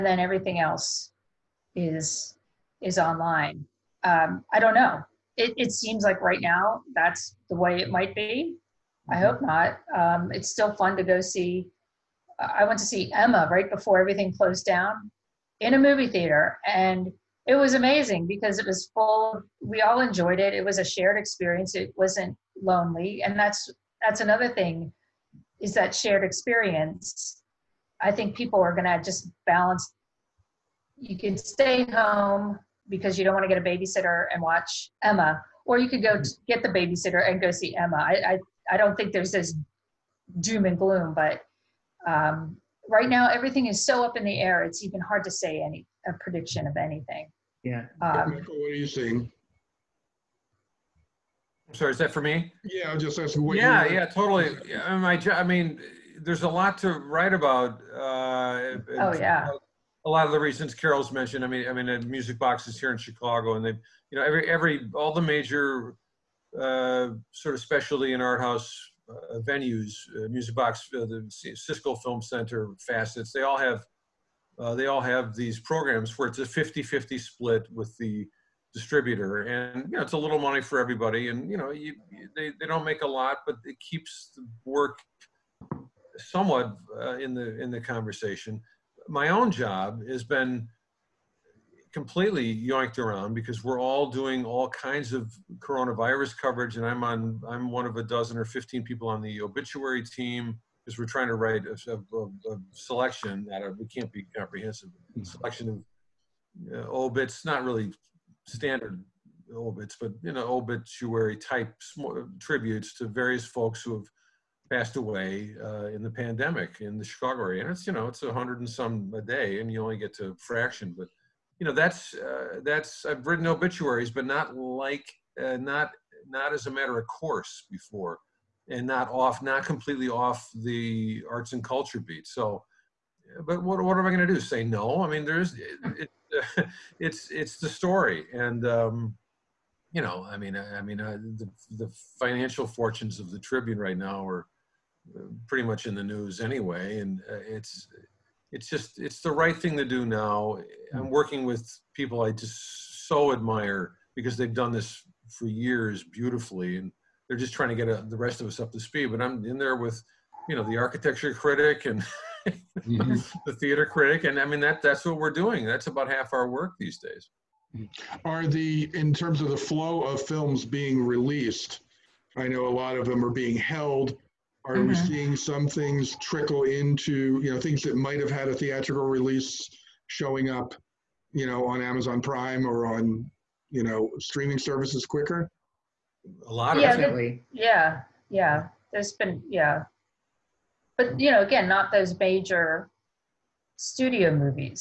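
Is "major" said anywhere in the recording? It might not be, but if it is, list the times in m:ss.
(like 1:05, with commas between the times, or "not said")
1:05, 3:12.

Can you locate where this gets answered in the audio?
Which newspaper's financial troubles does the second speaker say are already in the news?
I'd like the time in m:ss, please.
2:23.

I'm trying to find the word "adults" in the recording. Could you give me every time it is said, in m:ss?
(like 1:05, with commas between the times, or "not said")
not said.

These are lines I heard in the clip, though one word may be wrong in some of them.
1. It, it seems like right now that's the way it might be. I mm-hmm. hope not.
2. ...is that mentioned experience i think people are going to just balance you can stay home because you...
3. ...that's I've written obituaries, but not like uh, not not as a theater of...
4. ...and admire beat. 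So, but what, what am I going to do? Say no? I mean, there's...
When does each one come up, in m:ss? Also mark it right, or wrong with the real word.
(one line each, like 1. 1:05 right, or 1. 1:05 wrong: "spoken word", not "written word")
1. 0:05 right
2. 0:25 wrong: "shared", not "mentioned"
3. 2:02 wrong: "matter", not "theater"
4. 2:11 wrong: "culture", not "admire".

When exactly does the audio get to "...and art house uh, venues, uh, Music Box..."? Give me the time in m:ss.
1:08.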